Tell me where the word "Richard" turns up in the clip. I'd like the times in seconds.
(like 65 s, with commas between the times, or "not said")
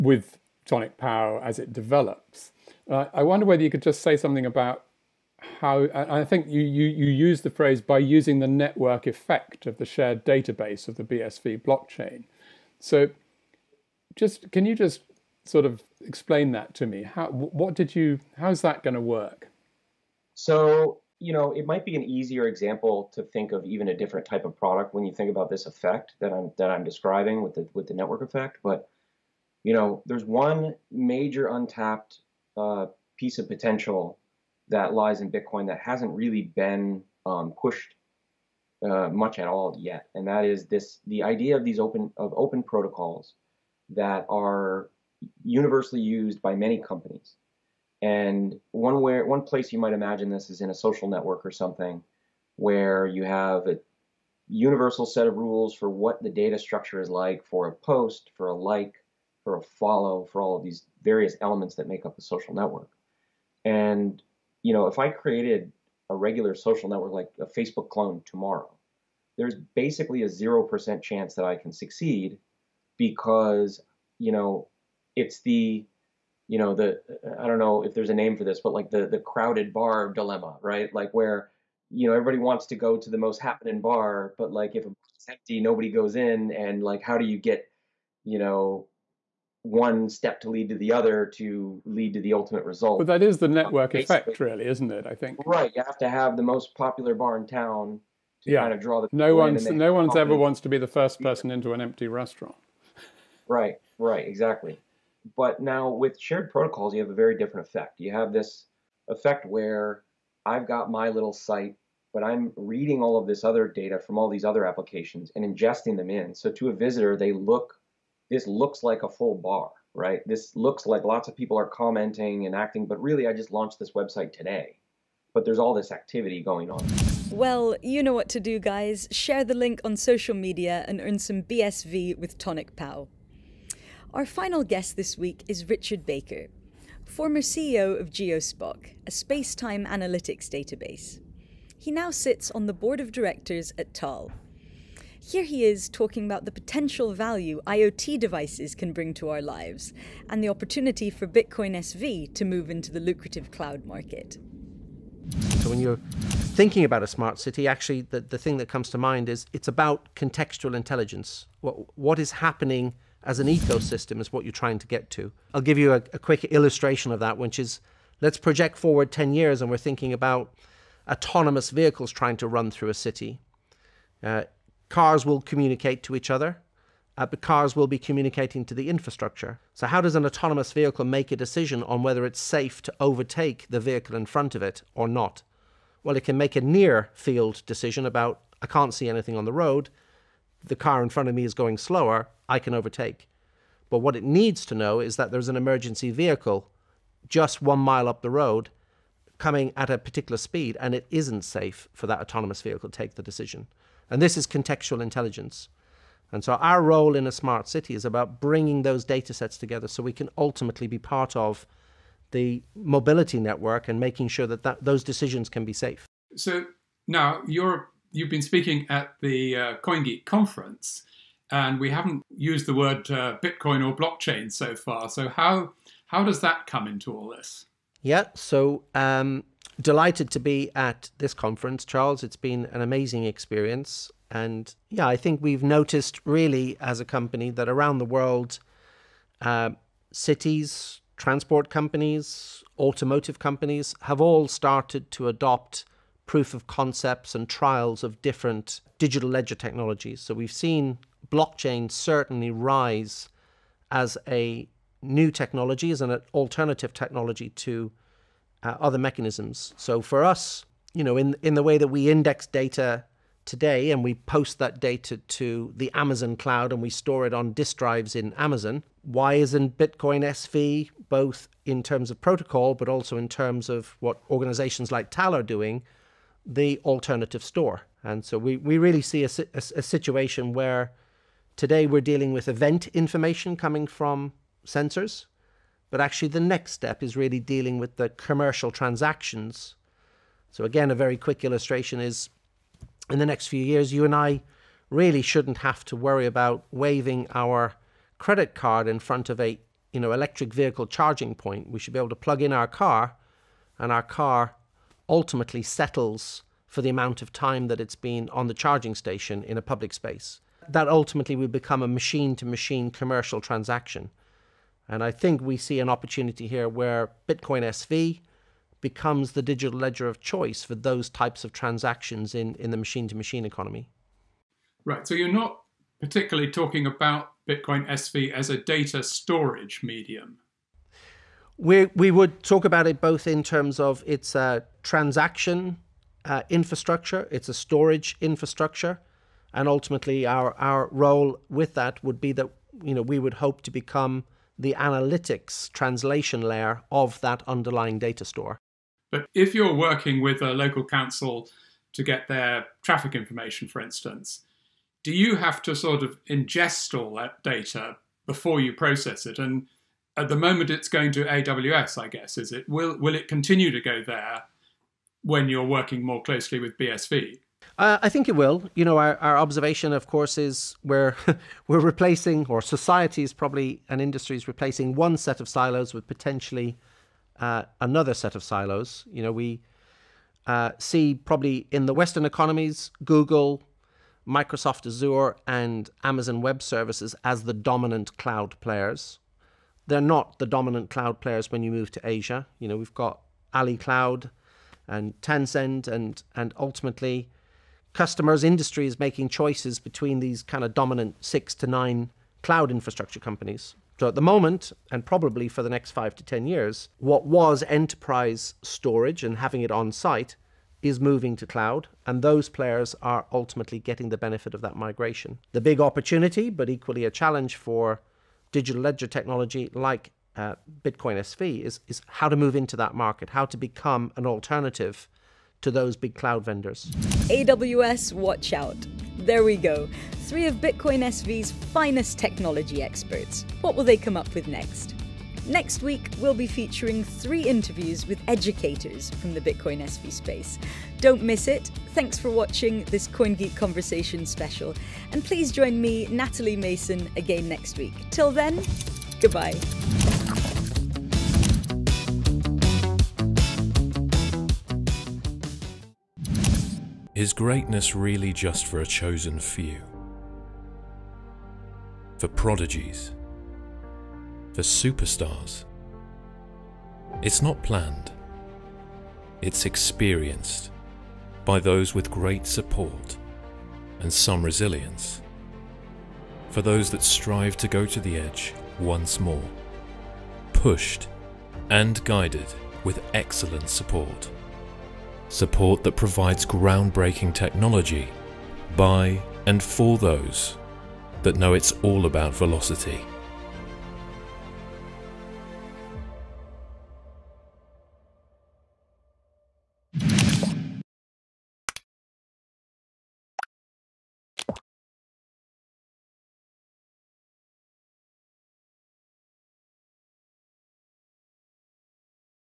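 135 s.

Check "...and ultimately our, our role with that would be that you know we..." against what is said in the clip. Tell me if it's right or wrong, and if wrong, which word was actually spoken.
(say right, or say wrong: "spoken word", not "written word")
right.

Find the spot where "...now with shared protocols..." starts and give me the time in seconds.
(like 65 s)
105 s.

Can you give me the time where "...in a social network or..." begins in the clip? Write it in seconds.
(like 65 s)
50 s.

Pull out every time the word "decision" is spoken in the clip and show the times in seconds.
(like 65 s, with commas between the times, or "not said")
181 s, 187 s, 203 s, 215 s.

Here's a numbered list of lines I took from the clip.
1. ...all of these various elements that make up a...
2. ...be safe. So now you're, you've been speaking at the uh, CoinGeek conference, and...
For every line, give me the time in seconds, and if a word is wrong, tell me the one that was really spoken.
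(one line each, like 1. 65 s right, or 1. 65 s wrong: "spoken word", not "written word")
1. 60 s right
2. 215 s right.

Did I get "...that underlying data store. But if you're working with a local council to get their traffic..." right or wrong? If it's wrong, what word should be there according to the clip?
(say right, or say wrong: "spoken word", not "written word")
right.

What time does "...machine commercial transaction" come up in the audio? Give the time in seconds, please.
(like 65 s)
312 s.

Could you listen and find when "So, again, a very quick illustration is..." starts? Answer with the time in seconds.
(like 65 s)
290 s.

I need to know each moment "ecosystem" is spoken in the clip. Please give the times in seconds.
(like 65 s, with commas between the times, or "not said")
163 s.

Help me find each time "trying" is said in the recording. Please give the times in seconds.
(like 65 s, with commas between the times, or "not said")
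164 s, 172 s.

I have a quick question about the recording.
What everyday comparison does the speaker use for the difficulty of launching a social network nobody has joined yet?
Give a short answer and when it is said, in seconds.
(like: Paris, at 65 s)
crowded bar dilemma, at 79 s.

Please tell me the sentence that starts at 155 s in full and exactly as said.
So when you're thinking about a smart city, actually the, the thing that comes to mind is it's about contextual intelligence.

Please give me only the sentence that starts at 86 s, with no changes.
And like, how do you get, you know, one step to lead to the other to lead to the ultimate result.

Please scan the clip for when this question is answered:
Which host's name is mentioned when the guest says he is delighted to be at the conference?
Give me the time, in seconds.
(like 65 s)
231 s.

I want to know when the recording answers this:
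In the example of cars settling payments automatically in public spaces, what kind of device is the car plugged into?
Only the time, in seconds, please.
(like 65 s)
300 s.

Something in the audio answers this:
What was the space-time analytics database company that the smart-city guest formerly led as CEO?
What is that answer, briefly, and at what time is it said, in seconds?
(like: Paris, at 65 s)
Geospock, at 138 s.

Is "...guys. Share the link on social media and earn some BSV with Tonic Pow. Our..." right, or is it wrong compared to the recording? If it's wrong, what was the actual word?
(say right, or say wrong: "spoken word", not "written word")
right.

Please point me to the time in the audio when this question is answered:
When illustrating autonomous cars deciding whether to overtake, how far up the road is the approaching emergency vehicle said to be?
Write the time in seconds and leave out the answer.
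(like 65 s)
197 s.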